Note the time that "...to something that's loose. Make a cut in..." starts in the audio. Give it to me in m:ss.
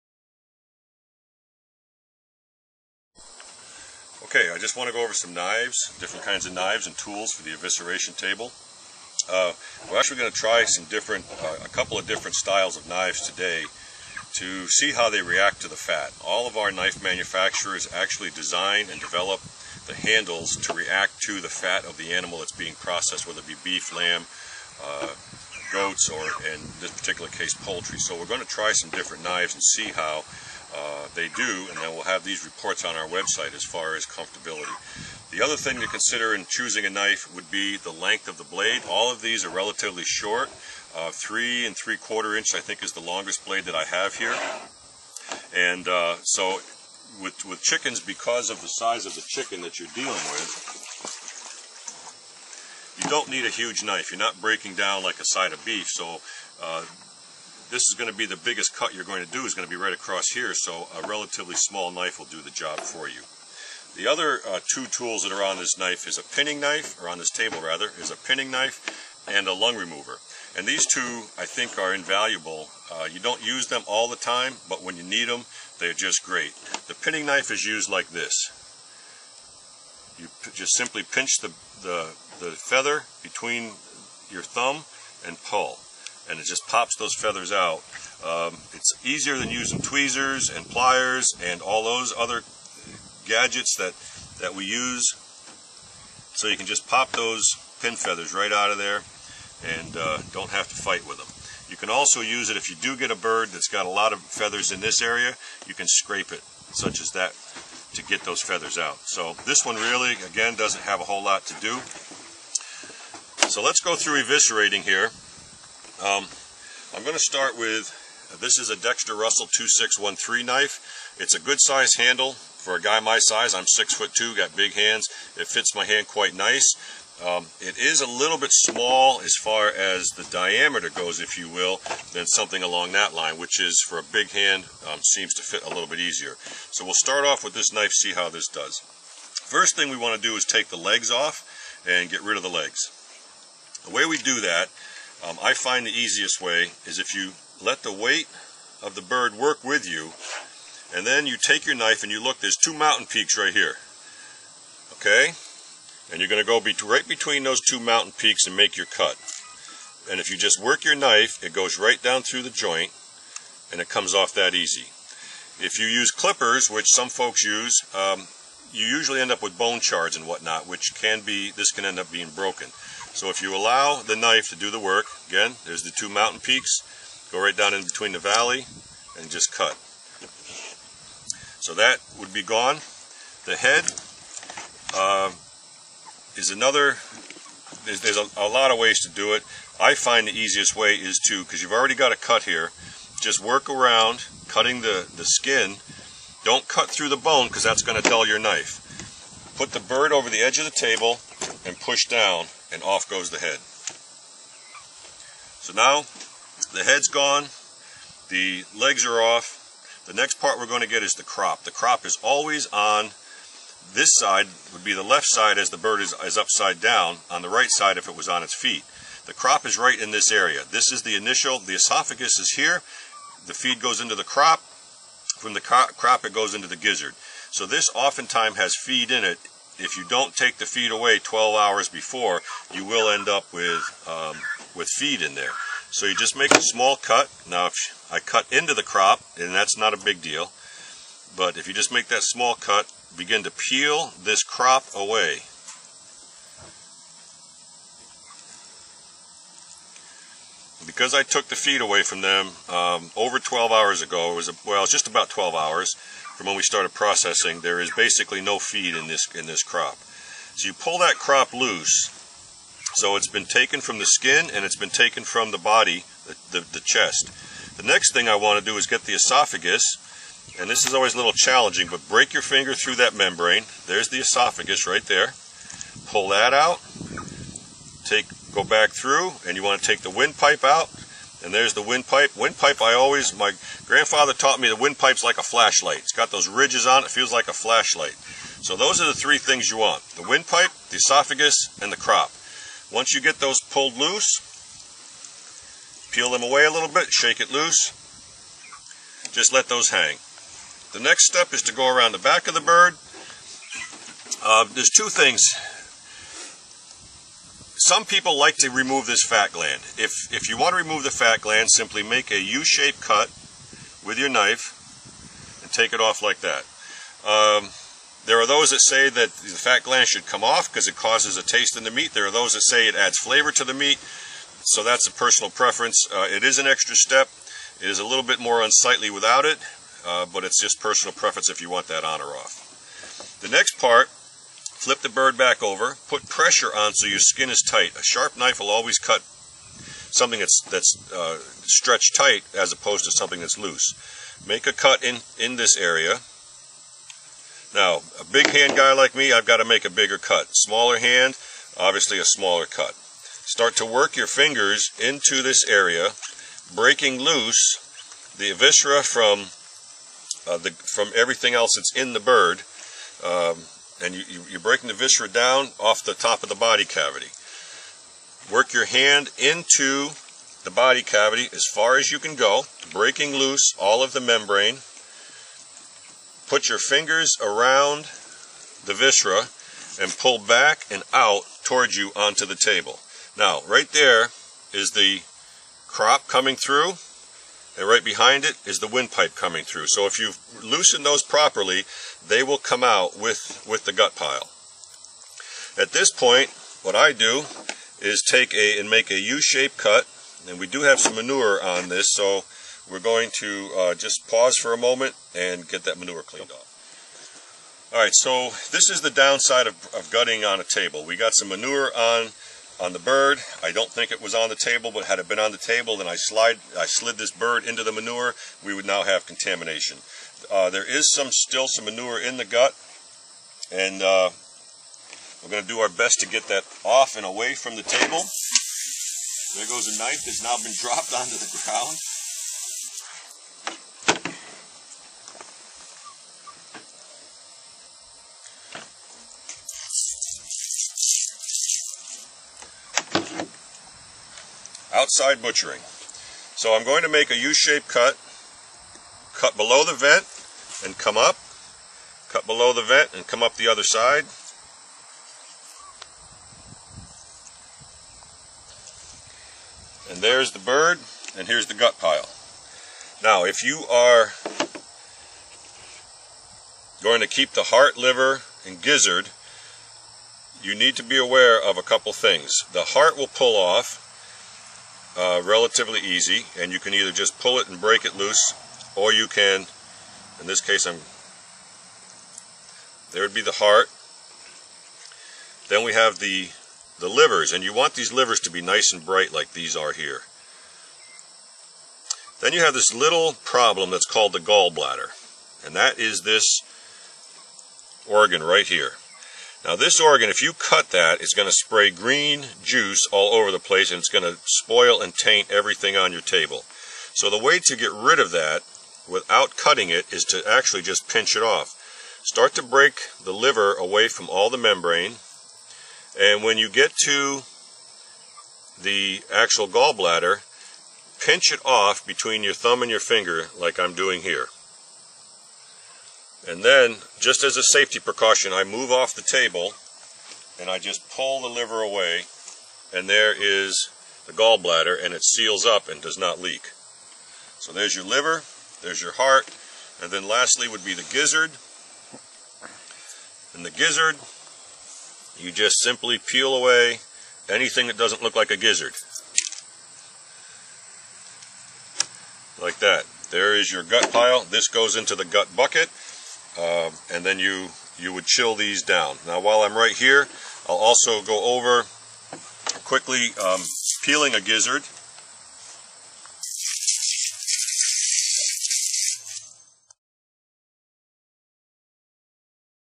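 5:43.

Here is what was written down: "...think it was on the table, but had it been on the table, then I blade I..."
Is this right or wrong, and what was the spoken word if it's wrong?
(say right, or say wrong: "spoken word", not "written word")
wrong: "slide", not "blade".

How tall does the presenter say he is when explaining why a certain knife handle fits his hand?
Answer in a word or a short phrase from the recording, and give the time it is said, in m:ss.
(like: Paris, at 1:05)
6 foot 2, at 2:03.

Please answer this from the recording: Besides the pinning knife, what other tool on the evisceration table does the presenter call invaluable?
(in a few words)
lung remover.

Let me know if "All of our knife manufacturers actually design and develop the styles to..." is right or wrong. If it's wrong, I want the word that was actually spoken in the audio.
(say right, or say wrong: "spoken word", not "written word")
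wrong: "handles", not "styles".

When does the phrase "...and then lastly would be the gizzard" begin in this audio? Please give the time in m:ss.
9:00.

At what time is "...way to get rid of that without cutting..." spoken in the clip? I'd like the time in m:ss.
8:27.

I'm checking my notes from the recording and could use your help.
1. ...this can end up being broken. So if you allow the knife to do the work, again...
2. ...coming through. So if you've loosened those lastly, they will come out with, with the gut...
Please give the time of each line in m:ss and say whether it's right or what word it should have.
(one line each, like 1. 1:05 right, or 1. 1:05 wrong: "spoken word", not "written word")
1. 2:51 right
2. 6:29 wrong: "properly", not "lastly".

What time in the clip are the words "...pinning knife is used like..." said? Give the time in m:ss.
1:16.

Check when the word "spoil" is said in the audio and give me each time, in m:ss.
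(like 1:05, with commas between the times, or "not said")
8:24.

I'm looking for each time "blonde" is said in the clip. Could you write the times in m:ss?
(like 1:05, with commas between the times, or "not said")
not said.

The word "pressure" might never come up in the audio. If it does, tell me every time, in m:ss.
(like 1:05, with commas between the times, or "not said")
5:36.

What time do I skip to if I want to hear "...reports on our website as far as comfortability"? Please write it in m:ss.
0:32.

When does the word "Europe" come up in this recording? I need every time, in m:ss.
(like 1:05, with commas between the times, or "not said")
not said.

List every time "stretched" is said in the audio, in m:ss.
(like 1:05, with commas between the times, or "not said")
5:41.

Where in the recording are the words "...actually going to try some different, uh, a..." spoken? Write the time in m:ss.
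0:09.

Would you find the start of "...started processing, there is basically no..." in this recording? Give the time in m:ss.
4:16.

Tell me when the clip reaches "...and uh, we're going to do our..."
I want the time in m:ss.
7:03.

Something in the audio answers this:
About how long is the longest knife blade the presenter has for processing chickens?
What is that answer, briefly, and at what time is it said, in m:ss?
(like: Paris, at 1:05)
3 3/4 inch, at 0:41.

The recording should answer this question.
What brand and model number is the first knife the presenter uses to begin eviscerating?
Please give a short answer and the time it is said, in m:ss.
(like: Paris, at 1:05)
Dexter Russell 2613, at 1:58.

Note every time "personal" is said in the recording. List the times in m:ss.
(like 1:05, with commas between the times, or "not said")
5:25, 5:30.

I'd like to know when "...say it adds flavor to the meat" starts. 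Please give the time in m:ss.
5:22.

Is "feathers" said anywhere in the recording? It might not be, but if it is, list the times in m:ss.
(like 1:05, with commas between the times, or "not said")
1:22, 1:27, 1:37, 1:44, 1:48.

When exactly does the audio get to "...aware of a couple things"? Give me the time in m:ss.
7:51.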